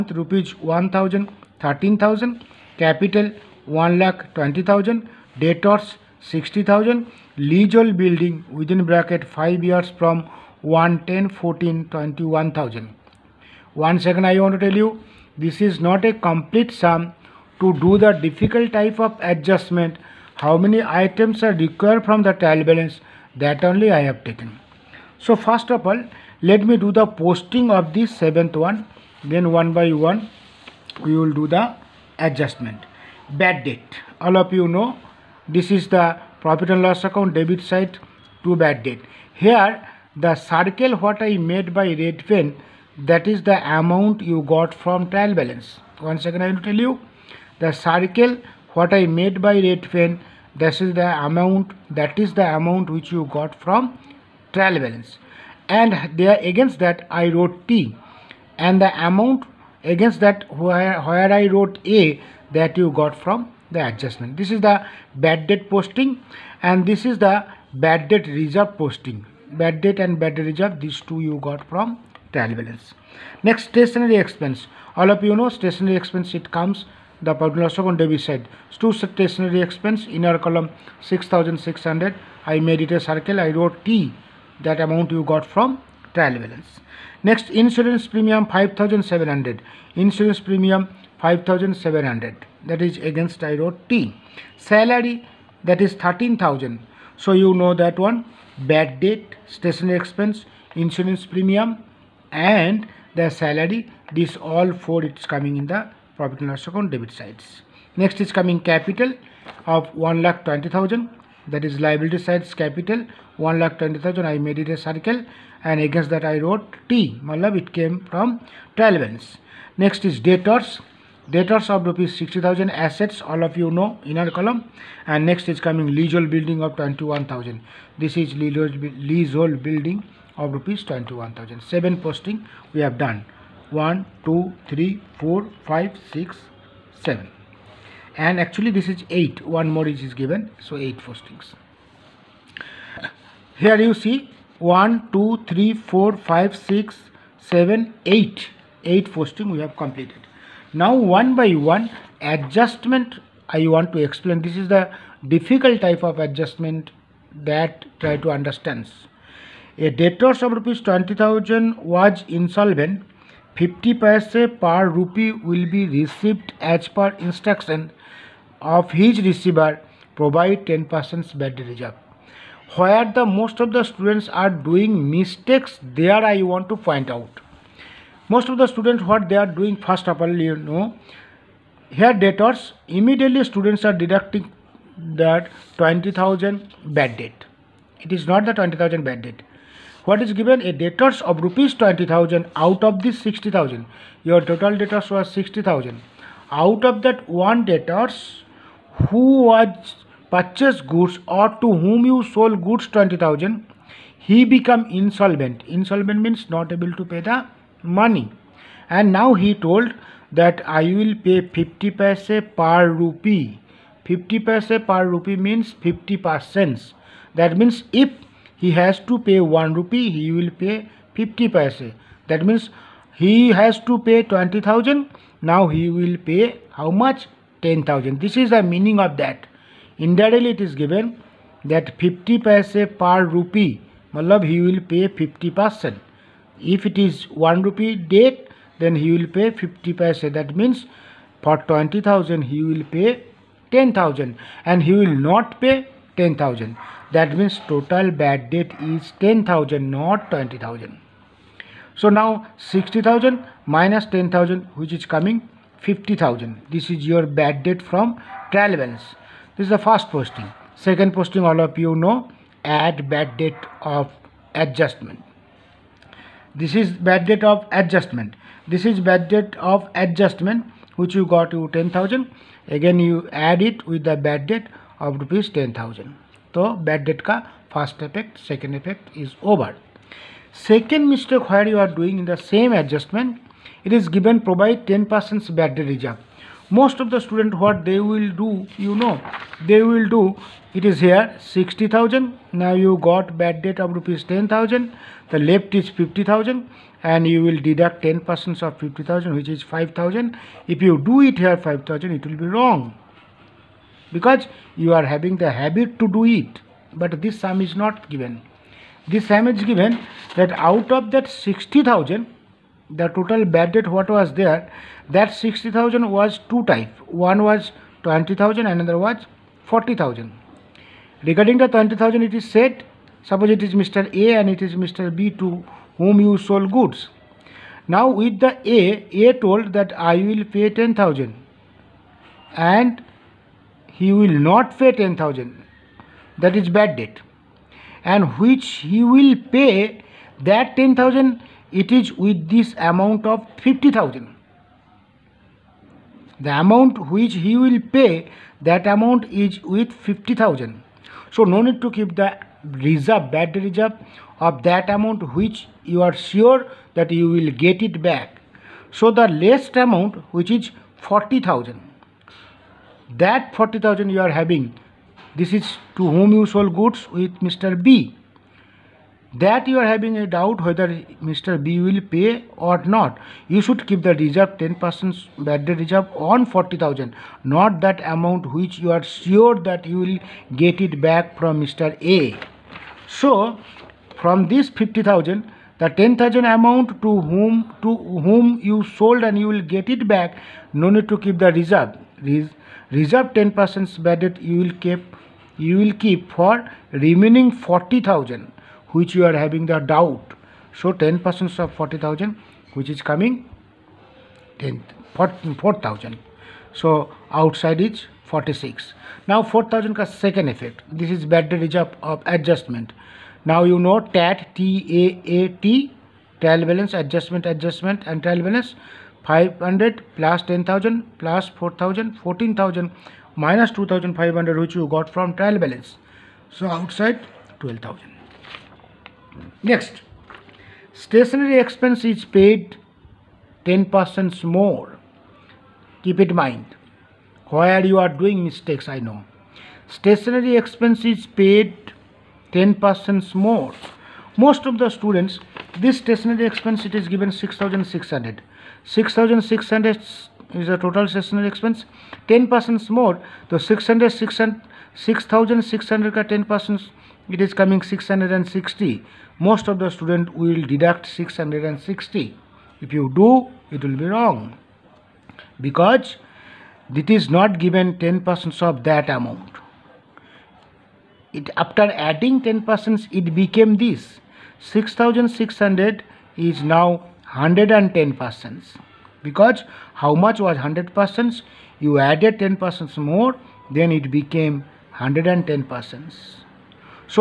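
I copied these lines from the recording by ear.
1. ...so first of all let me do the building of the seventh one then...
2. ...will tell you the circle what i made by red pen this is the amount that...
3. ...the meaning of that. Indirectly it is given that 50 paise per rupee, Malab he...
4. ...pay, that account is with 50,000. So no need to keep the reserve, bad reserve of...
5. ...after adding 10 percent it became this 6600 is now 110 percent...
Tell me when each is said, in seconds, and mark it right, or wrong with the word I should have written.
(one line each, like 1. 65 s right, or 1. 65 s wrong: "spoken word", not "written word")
1. 25 s wrong: "posting", not "building"
2. 46 s right
3. 228 s right
4. 347 s wrong: "amount", not "account"
5. 471 s right.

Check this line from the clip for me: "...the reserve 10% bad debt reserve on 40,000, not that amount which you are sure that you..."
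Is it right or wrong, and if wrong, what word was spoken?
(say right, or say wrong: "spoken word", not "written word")
right.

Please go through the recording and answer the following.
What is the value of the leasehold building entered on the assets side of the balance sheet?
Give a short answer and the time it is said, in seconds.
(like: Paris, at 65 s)
21,000, at 125 s.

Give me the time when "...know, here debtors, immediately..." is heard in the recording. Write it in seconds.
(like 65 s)
180 s.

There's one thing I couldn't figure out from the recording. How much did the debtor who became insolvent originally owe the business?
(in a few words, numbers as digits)
20,000.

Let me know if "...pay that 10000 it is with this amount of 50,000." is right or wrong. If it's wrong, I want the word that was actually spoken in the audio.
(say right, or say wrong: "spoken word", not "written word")
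right.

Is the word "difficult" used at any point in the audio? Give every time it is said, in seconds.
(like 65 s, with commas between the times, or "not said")
18 s, 155 s.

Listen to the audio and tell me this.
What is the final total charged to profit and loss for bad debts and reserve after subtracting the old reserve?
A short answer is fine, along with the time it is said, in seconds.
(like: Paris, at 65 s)
12,000, at 427 s.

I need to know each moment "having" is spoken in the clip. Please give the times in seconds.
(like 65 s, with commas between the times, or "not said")
305 s, 364 s, 369 s, 399 s.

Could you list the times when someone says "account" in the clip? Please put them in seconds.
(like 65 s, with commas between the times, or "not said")
37 s, 106 s.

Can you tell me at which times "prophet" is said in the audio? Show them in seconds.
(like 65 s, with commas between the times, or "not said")
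not said.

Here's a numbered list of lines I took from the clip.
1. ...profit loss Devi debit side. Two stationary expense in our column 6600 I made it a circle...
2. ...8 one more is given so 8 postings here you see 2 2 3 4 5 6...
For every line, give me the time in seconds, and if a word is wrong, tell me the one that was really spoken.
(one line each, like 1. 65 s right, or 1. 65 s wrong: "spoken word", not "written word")
1. 77 s right
2. 139 s wrong: "1", not "2".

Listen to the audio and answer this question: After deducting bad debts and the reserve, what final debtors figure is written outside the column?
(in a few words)
46,000.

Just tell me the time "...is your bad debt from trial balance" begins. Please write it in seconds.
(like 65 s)
256 s.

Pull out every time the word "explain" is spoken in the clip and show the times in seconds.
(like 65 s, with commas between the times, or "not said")
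154 s.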